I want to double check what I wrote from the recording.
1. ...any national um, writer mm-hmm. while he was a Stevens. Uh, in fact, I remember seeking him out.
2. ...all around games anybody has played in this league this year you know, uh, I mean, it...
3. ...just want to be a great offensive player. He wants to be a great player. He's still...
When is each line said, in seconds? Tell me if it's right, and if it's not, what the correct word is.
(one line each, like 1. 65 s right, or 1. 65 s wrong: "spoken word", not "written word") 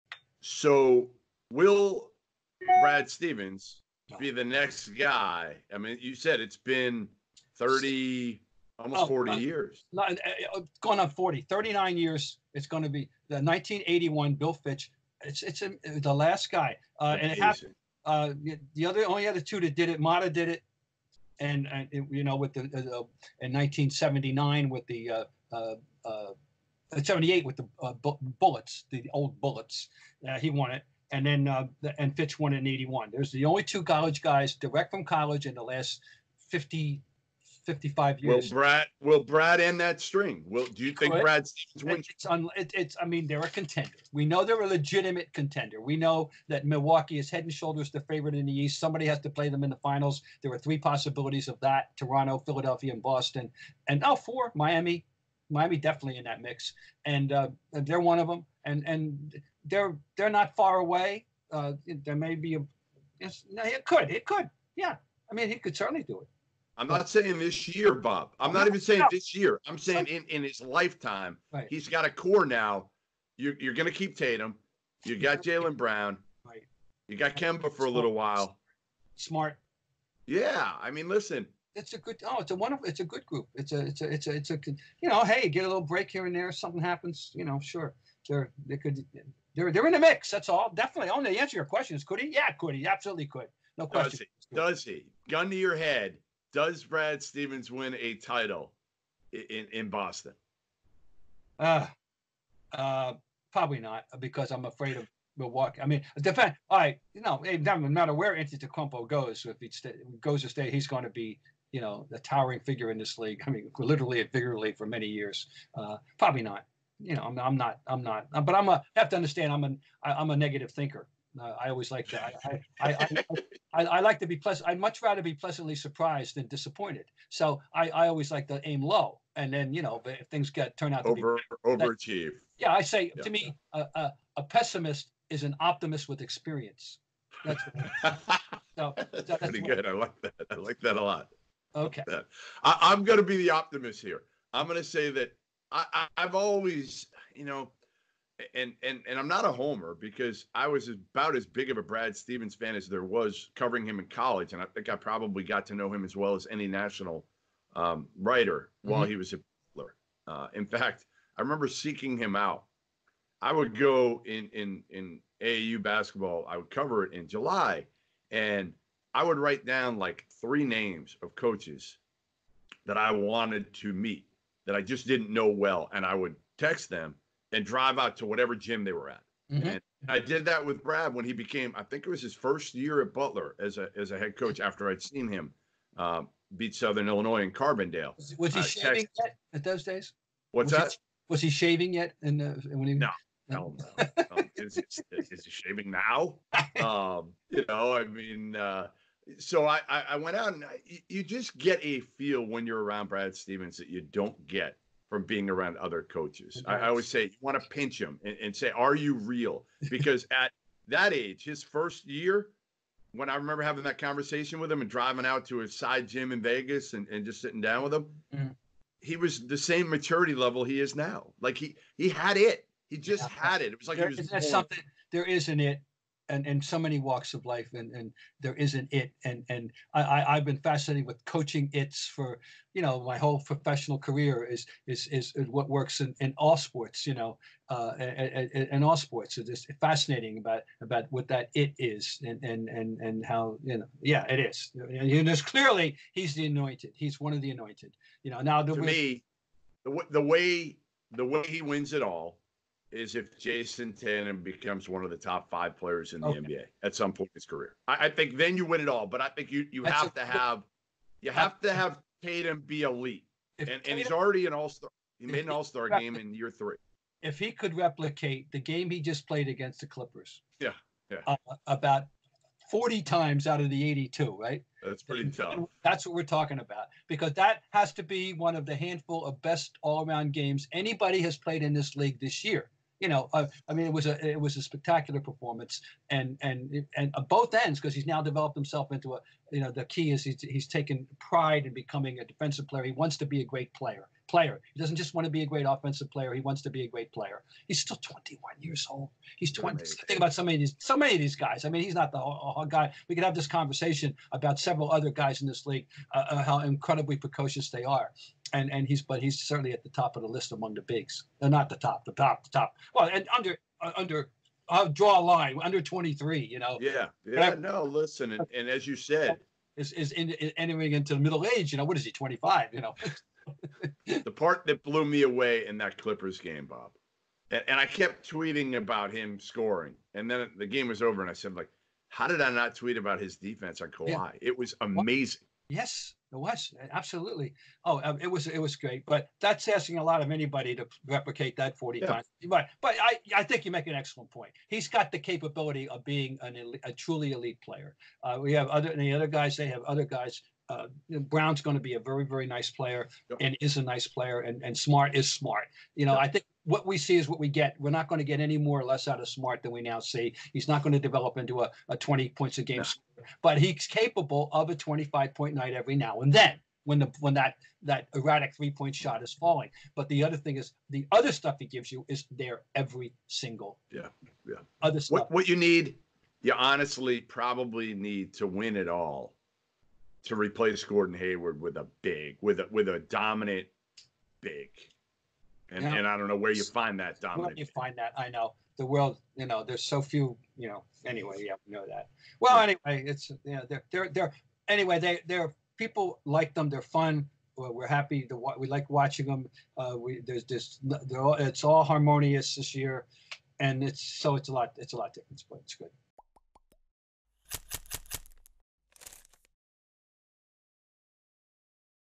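1. 156 s wrong: "Butler", not "Stevens"
2. 279 s right
3. 294 s right.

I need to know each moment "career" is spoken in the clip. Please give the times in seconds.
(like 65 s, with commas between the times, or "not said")
233 s, 257 s.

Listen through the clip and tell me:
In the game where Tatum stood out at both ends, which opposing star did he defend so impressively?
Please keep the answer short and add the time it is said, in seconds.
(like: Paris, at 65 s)
Kawhi, at 333 s.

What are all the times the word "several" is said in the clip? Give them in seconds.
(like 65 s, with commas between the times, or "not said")
304 s.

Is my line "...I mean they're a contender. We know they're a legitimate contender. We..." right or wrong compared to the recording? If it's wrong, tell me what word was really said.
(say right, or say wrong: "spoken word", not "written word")
right.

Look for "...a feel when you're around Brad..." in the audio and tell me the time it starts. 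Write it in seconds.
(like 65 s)
201 s.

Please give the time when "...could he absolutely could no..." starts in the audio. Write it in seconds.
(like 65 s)
92 s.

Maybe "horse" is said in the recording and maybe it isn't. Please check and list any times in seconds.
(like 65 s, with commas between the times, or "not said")
not said.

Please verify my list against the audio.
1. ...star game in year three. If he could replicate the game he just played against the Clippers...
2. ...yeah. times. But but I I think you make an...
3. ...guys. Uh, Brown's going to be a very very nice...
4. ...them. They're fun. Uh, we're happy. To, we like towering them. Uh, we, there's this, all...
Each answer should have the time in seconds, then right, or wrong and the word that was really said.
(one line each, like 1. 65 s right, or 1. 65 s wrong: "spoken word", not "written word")
1. 265 s right
2. 341 s right
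3. 350 s right
4. 396 s wrong: "watching", not "towering".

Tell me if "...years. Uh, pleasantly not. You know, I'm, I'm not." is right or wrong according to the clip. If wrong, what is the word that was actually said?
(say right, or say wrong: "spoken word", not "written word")
wrong: "probably", not "pleasantly".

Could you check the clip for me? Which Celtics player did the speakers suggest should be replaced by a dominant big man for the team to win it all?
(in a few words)
Gordon Hayward.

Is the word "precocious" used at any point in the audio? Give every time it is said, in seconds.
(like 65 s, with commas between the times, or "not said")
307 s.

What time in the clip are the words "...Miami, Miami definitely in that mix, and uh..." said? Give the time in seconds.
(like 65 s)
54 s.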